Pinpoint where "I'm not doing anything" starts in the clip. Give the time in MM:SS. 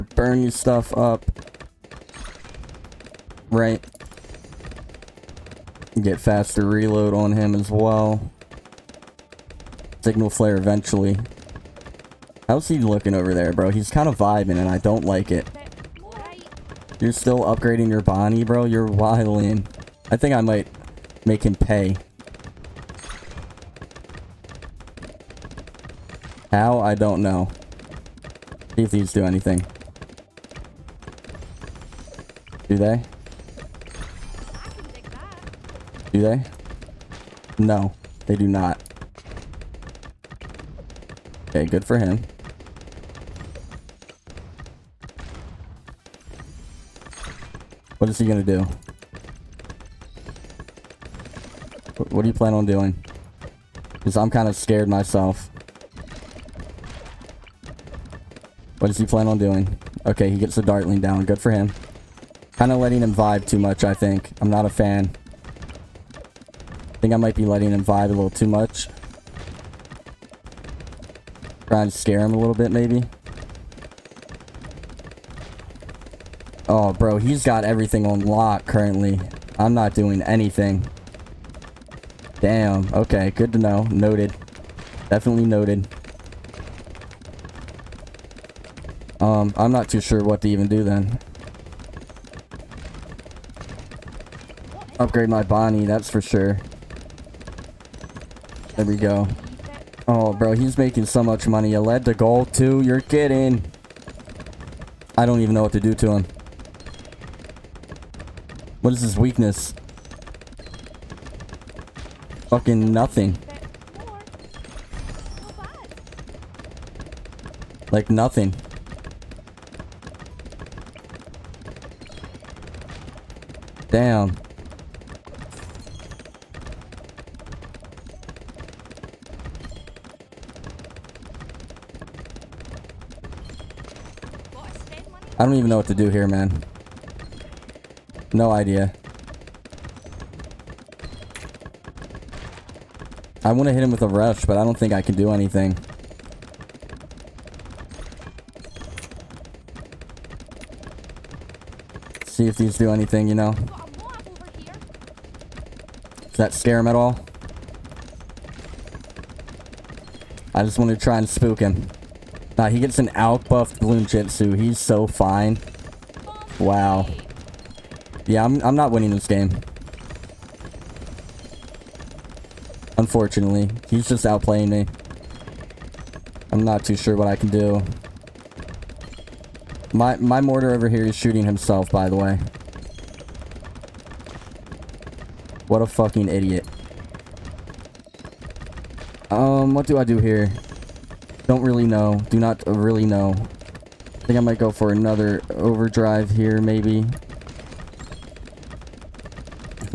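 01:19.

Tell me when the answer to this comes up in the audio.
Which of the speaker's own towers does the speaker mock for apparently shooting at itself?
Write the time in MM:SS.
03:00.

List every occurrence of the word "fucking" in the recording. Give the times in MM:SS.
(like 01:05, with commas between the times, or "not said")
01:52, 03:05.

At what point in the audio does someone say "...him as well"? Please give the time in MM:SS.
00:07.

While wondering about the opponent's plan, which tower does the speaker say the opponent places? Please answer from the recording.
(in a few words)
Dartling.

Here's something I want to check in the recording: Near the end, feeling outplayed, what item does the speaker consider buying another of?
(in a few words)
overdrive.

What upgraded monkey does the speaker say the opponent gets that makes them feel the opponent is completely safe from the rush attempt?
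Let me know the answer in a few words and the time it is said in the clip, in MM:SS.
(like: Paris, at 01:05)
Bloonjitsu, at 02:43.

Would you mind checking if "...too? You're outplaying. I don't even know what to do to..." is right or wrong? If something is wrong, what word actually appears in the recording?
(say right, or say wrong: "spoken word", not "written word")
wrong: "kidding", not "outplaying".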